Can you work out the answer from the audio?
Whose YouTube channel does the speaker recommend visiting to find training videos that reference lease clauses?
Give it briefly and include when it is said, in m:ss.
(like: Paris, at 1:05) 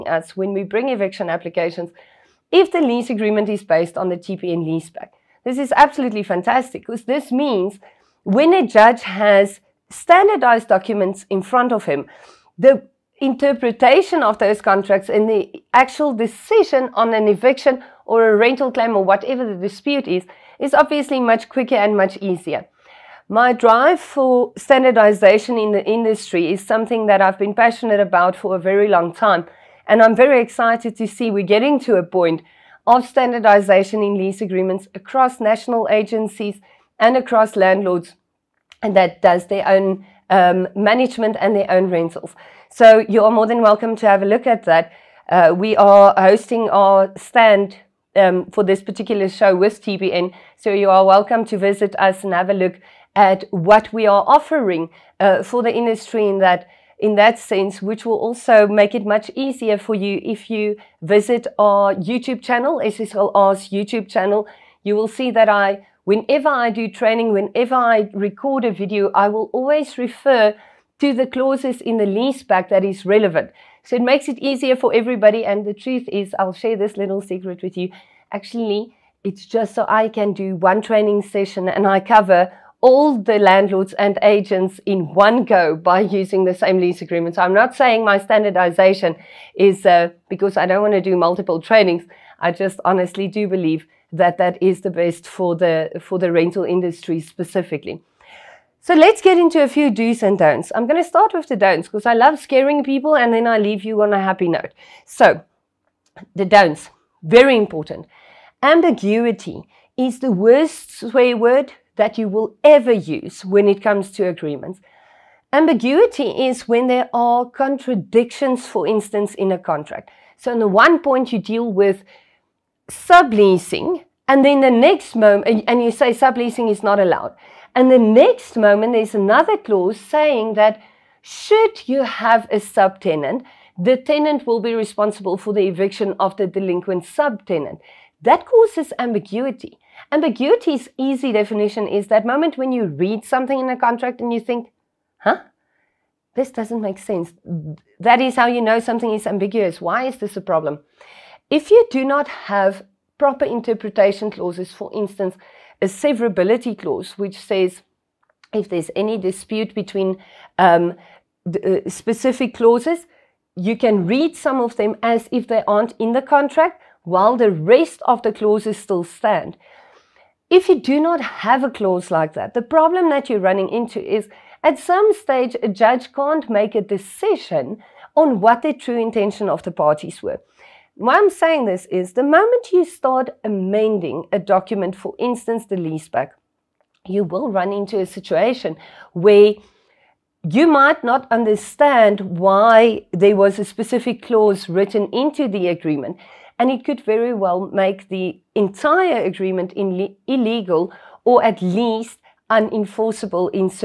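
SSLR, at 1:02.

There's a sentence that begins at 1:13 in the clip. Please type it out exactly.
So it makes it easier for everybody.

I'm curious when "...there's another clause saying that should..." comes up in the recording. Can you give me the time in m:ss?
2:08.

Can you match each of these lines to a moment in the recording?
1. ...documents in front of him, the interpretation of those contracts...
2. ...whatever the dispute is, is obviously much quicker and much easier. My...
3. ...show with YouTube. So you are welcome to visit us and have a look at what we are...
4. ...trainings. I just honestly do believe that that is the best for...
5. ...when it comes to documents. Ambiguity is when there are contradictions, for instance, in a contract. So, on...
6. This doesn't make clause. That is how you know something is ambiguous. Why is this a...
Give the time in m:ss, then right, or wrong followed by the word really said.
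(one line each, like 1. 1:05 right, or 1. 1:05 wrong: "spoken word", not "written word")
1. 0:10 right
2. 0:19 right
3. 0:49 wrong: "TPN", not "YouTube"
4. 1:31 right
5. 1:53 wrong: "agreements", not "documents"
6. 2:26 wrong: "sense", not "clause".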